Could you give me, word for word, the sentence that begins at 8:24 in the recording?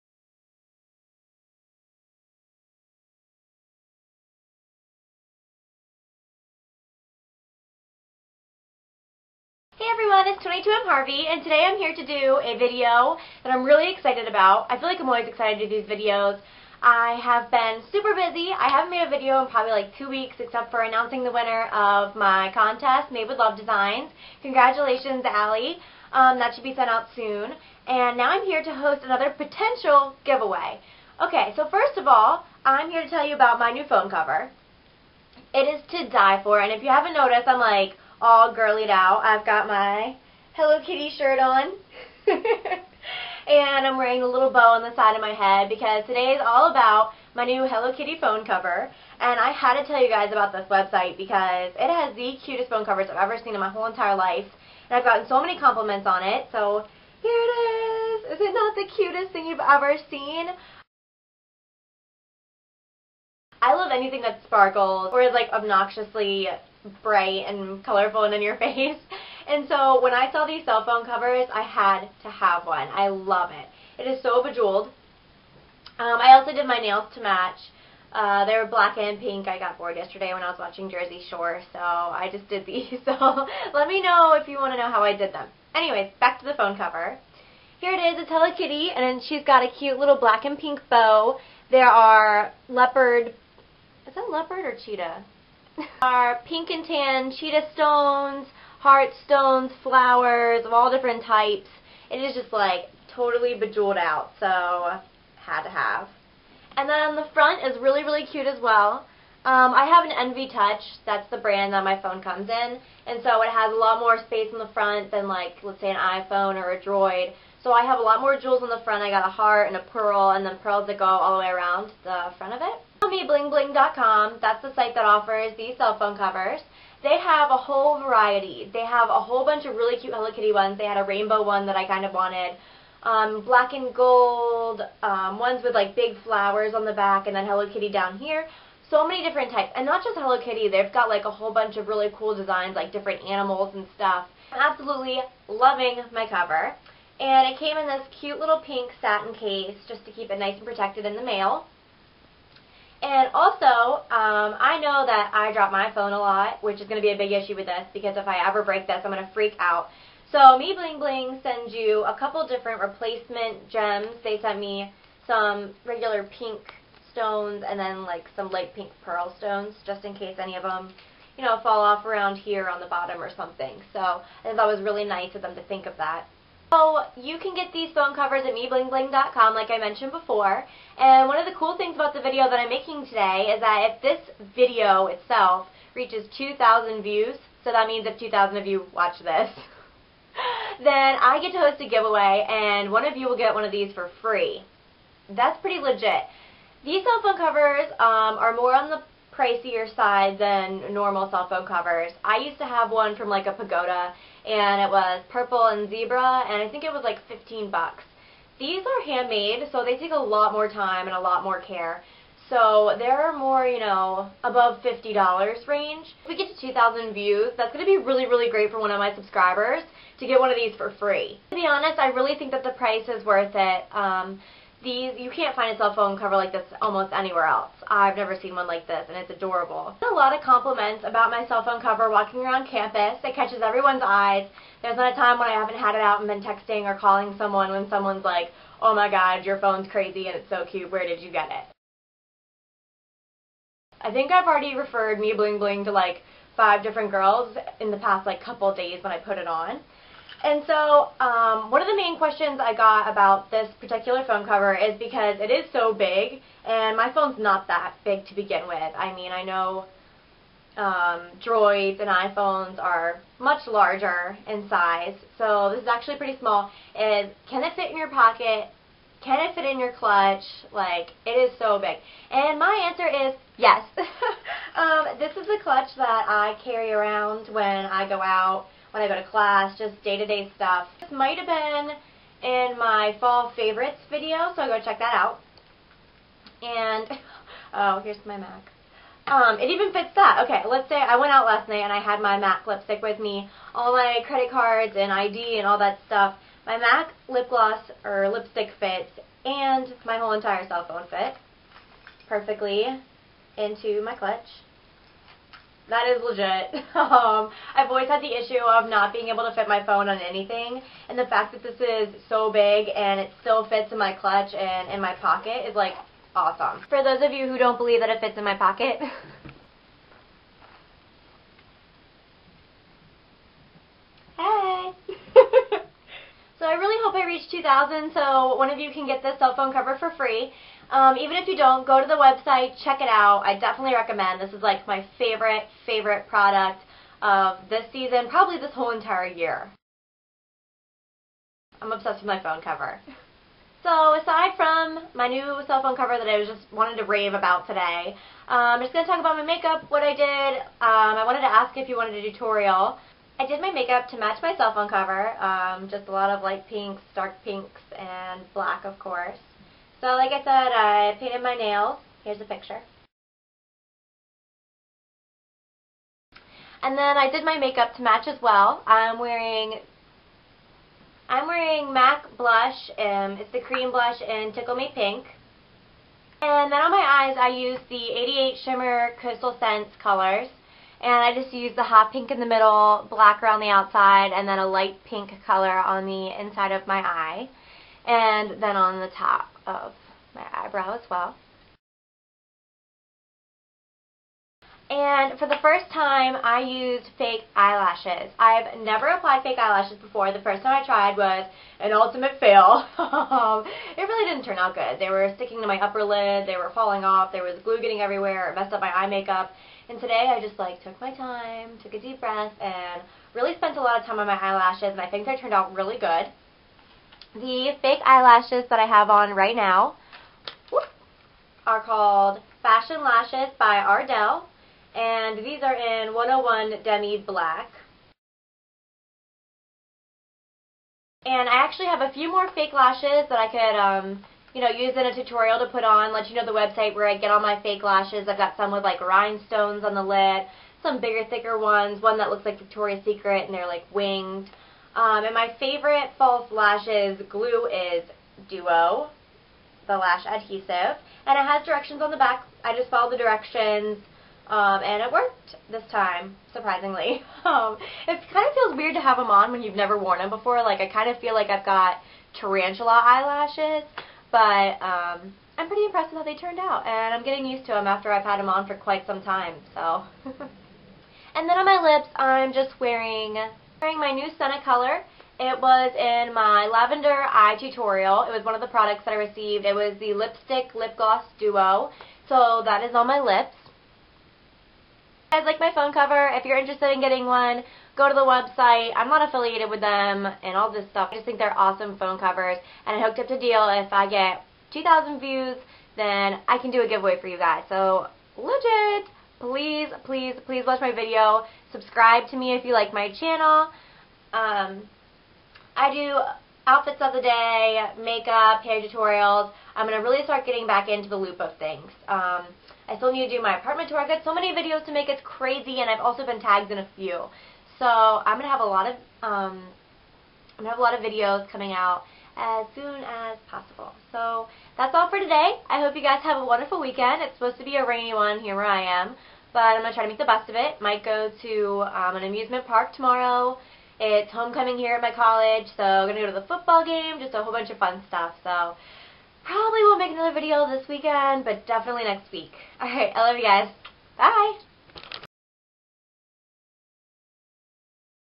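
Um, I do outfits of the day, makeup, hair tutorials.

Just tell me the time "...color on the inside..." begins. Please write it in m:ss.
6:25.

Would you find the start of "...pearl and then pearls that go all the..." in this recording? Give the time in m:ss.
1:59.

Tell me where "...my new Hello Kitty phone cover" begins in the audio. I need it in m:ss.
0:47.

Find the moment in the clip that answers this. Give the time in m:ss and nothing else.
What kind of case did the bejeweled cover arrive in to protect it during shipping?
2:28.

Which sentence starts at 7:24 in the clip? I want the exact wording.
Um, and my favorite false lashes glue is Duo, the lash adhesive.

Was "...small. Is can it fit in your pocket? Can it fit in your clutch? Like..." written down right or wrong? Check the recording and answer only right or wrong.
right.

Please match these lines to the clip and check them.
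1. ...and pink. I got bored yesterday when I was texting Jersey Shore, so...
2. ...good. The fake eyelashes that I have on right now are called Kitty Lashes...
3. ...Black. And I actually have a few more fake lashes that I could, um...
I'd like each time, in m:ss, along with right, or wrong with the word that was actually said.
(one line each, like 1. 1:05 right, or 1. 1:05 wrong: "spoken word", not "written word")
1. 1:18 wrong: "watching", not "texting"
2. 6:55 wrong: "Fashion", not "Kitty"
3. 7:07 right.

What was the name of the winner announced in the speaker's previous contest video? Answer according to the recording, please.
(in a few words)
Allie.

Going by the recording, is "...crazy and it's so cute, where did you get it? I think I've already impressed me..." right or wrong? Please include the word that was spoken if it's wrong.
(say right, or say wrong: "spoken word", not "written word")
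wrong: "referred", not "impressed".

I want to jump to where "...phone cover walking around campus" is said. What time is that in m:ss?
3:51.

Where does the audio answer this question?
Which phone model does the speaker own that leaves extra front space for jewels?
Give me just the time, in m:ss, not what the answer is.
1:50.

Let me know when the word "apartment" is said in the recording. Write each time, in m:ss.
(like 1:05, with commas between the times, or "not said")
8:33.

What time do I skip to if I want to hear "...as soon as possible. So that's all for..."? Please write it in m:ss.
8:42.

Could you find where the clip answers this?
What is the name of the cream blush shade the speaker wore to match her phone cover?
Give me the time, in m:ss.
6:14.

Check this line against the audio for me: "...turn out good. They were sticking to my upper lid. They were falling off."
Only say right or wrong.
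right.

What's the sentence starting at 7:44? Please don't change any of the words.
But um, I'm pretty impressed with how they turned out.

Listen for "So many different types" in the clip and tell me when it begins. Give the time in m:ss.
2:18.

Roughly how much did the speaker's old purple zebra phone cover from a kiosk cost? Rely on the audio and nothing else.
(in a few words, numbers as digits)
15 bucks.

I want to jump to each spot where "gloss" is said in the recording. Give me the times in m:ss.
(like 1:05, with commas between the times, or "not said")
4:57, 8:00.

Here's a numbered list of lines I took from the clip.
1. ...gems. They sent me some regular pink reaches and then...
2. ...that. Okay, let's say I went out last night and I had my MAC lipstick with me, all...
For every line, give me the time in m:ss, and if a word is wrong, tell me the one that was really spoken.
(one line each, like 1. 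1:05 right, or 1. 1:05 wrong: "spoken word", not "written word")
1. 2:43 wrong: "stones", not "reaches"
2. 4:50 right.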